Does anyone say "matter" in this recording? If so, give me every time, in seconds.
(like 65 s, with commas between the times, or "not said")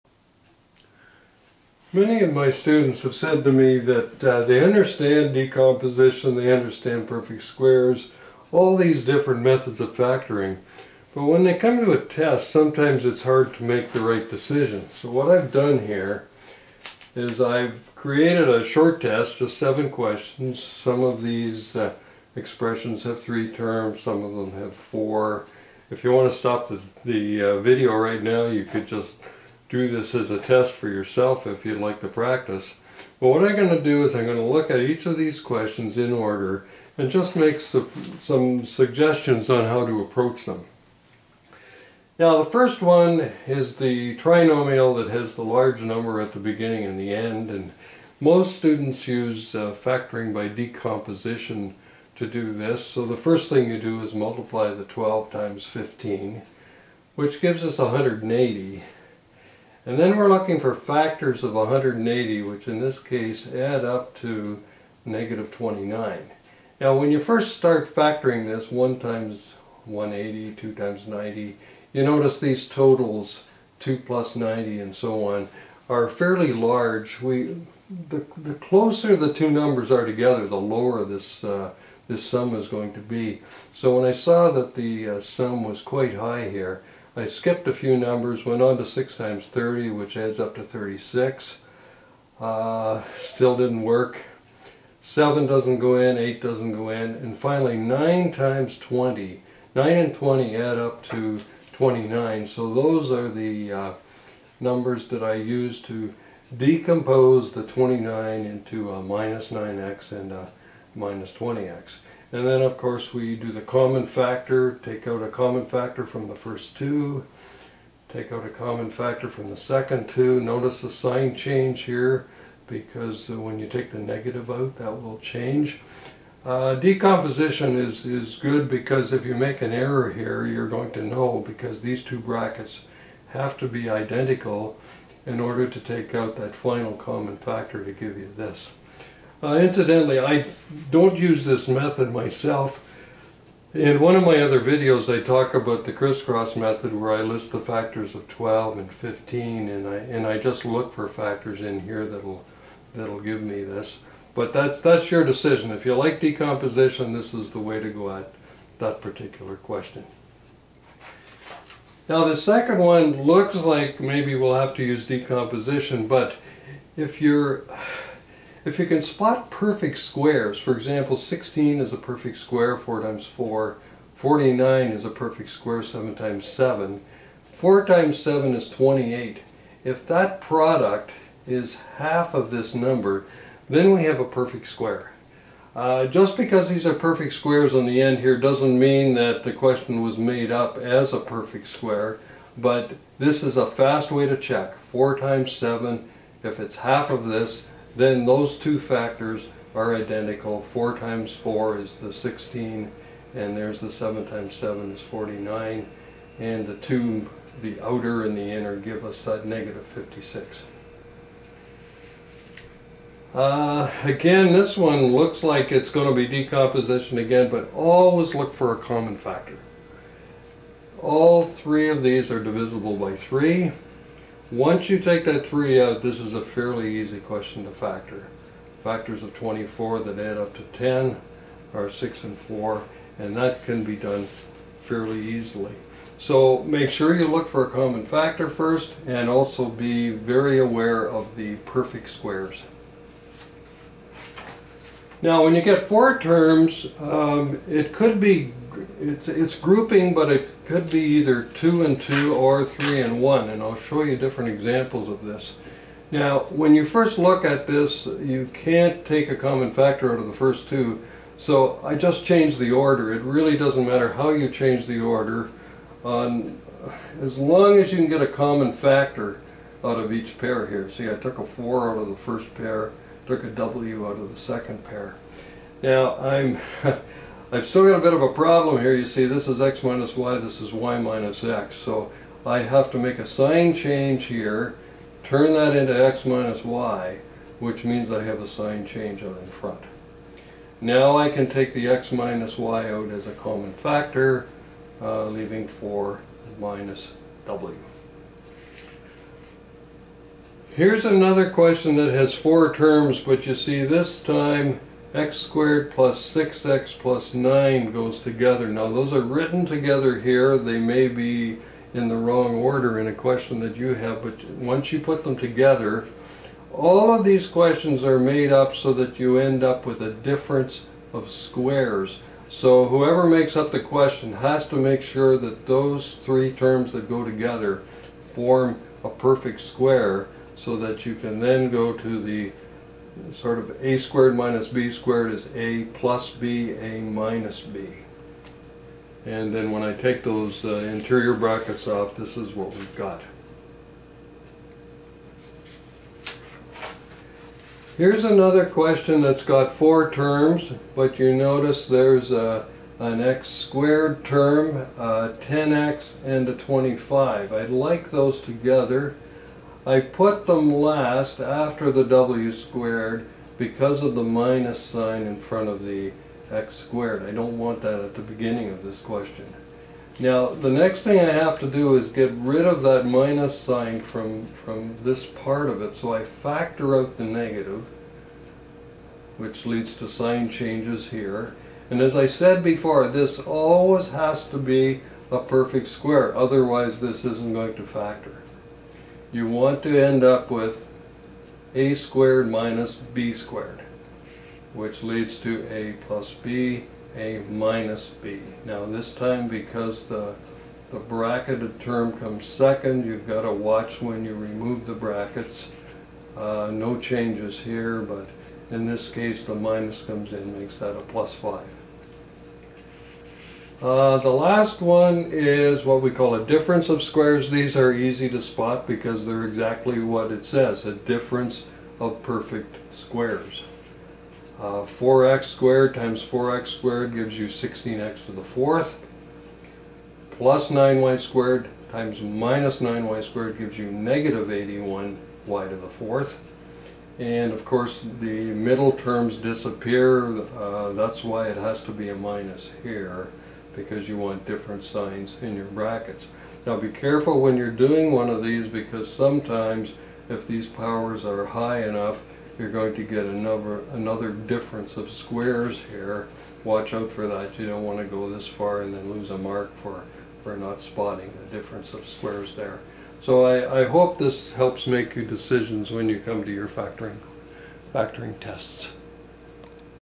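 263 s.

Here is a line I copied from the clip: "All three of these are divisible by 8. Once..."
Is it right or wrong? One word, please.
wrong.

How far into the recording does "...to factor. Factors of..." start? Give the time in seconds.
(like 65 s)
227 s.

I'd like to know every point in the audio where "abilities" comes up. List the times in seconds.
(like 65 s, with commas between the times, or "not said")
not said.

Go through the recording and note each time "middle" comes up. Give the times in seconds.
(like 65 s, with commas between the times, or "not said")
438 s.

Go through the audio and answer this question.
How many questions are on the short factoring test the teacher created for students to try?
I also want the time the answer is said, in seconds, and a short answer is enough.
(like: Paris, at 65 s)
7, at 19 s.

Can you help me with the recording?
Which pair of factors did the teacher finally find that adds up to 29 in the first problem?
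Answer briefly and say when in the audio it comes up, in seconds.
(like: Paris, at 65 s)
9 and 20, at 97 s.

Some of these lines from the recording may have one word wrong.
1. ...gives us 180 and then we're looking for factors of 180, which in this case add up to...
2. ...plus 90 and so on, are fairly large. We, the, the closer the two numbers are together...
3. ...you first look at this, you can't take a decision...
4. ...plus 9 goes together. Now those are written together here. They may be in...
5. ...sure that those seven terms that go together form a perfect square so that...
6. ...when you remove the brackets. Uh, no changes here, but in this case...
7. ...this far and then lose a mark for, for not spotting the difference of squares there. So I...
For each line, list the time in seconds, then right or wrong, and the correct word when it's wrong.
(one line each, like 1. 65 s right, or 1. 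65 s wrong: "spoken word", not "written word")
1. 57 s right
2. 74 s right
3. 256 s wrong: "common", not "decision"
4. 306 s right
5. 325 s wrong: "three", not "seven"
6. 404 s right
7. 458 s right.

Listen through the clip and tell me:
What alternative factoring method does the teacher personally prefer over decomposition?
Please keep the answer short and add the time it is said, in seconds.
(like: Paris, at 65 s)
crisscross method, at 145 s.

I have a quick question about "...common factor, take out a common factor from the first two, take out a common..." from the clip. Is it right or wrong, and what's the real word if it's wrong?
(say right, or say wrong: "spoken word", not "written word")
right.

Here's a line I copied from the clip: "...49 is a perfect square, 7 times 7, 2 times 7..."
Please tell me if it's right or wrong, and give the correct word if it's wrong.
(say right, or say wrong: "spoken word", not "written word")
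wrong: "4", not "2".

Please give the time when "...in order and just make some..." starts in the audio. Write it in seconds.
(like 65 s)
35 s.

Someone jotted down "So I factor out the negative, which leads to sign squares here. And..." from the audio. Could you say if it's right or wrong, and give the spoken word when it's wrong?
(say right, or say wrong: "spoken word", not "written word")
wrong: "changes", not "squares".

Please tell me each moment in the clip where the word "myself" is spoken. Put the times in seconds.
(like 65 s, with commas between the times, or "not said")
142 s.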